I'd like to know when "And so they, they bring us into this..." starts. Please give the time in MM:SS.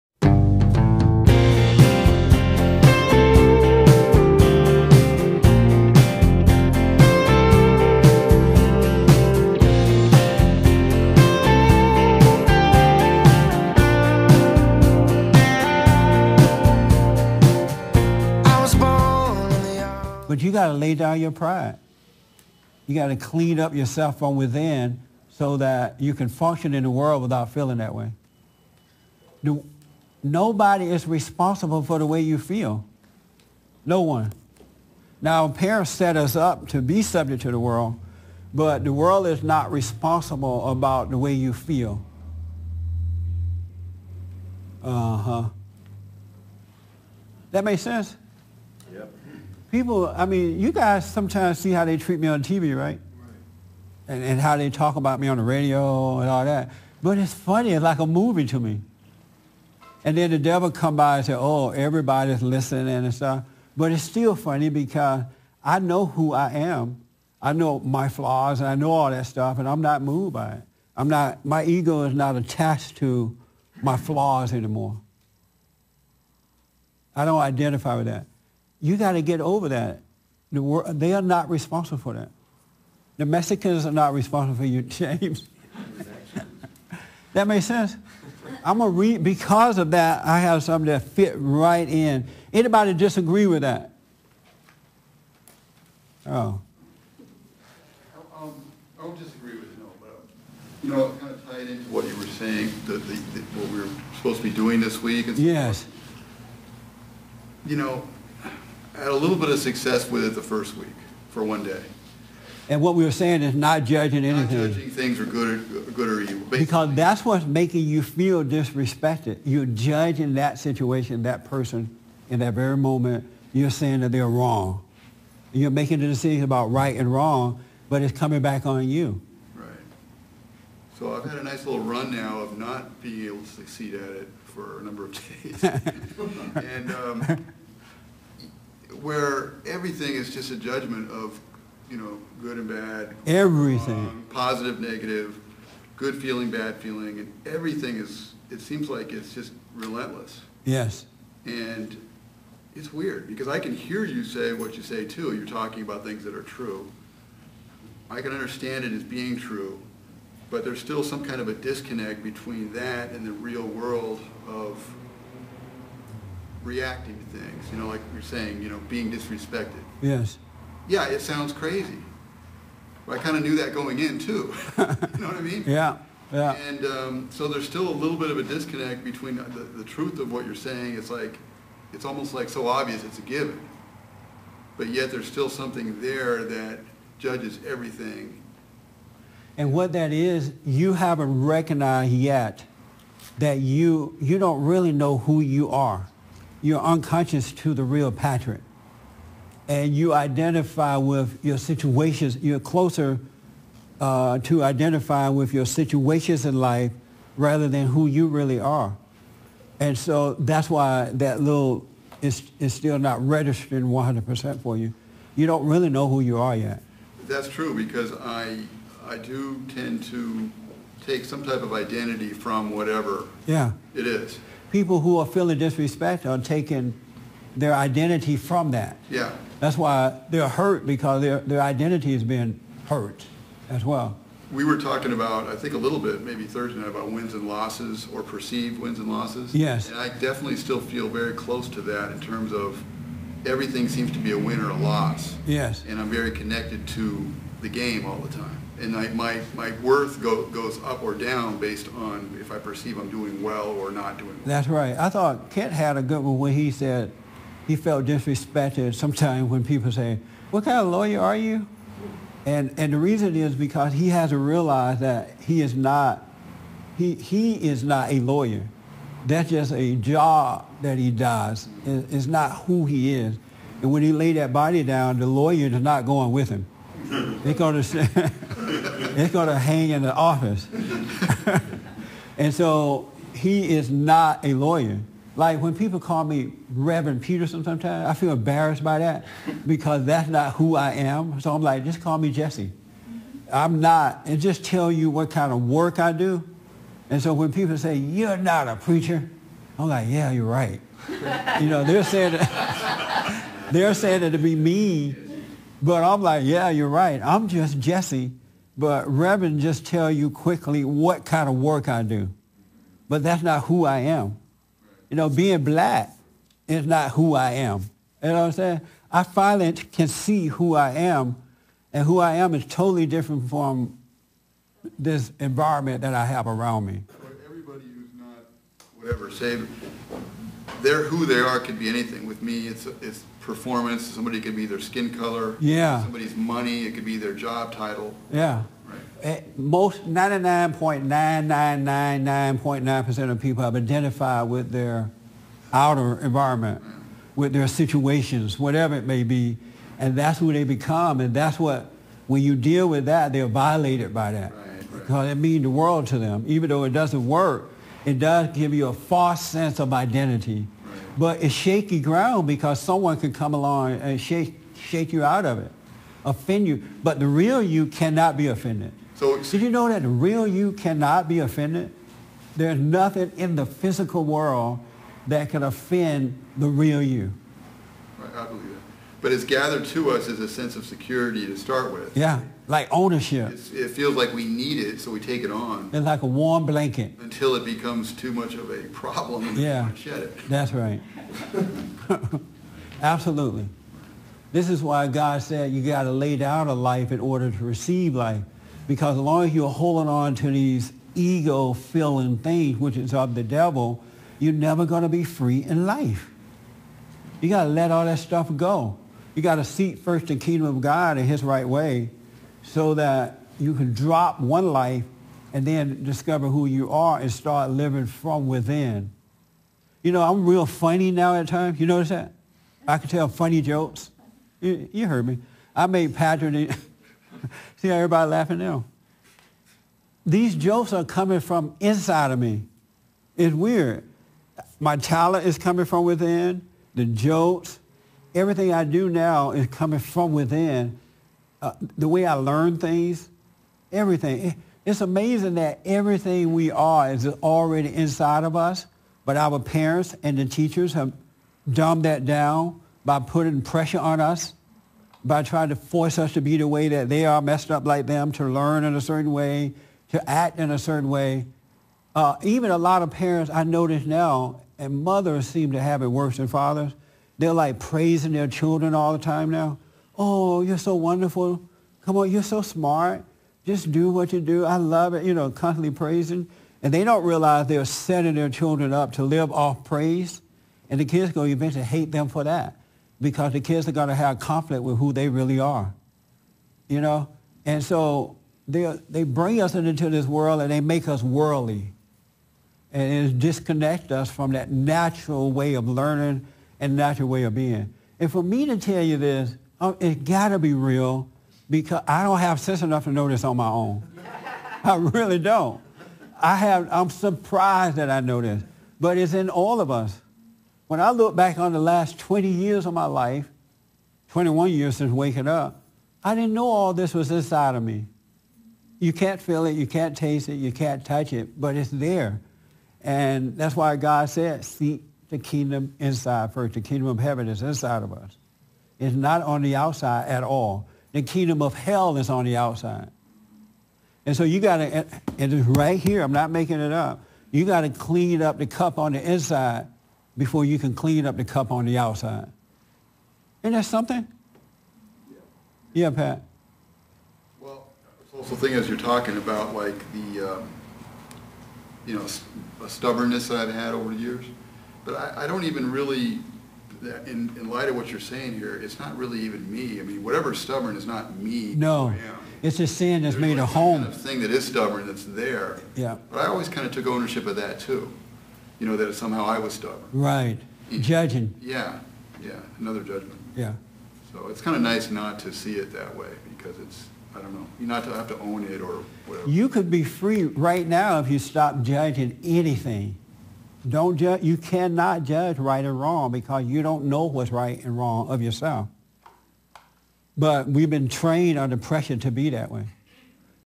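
08:07.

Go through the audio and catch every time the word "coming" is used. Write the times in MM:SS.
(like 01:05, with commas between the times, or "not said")
02:08, 07:11, 07:15, 07:19.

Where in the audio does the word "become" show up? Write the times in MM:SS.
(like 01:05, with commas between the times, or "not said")
05:50, 06:27.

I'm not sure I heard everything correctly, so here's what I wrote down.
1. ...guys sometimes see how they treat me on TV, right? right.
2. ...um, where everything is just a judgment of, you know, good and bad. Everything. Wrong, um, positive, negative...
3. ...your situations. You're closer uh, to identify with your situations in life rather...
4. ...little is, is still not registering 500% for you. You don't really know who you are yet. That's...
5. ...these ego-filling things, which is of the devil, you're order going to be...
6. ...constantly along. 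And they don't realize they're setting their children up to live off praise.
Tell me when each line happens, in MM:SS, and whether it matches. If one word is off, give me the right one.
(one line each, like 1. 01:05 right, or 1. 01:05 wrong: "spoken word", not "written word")
1. 00:50 right
2. 02:16 right
3. 03:21 right
4. 03:31 wrong: "100", not "500"
5. 06:40 wrong: "never", not "order"
6. 07:55 wrong: "praising", not "along".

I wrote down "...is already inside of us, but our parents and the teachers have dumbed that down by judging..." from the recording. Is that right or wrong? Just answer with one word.
wrong.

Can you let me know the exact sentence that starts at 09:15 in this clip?
But I, I don't even really, in, in light of what you're saying here, it's not really even me.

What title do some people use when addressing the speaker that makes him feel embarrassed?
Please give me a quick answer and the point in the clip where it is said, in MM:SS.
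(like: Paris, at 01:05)
Reverend Peterson, at 04:46.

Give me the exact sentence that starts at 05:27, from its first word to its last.
Everybody who's not whatever, say they're who they are could be anything.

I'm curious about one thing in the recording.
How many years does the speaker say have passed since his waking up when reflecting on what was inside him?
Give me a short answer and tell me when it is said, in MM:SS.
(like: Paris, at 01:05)
21, at 08:34.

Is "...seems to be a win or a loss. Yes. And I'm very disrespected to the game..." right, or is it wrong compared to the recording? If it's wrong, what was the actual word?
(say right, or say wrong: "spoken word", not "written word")
wrong: "connected", not "disrespected".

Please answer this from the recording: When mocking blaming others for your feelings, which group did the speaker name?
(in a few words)
The Mexicans.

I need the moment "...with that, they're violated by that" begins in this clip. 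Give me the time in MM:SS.
05:52.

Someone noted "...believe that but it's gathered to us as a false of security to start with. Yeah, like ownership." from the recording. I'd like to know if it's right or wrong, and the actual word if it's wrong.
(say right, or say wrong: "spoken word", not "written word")
wrong: "sense", not "false".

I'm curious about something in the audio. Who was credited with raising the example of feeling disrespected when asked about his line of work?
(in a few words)
Kent.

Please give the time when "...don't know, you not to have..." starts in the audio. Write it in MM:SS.
09:37.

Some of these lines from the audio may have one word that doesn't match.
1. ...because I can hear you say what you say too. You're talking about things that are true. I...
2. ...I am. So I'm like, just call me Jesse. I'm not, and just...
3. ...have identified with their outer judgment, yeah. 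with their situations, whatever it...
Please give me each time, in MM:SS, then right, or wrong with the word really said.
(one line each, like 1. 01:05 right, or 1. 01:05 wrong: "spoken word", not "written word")
1. 02:33 right
2. 04:50 right
3. 05:43 wrong: "environment", not "judgment".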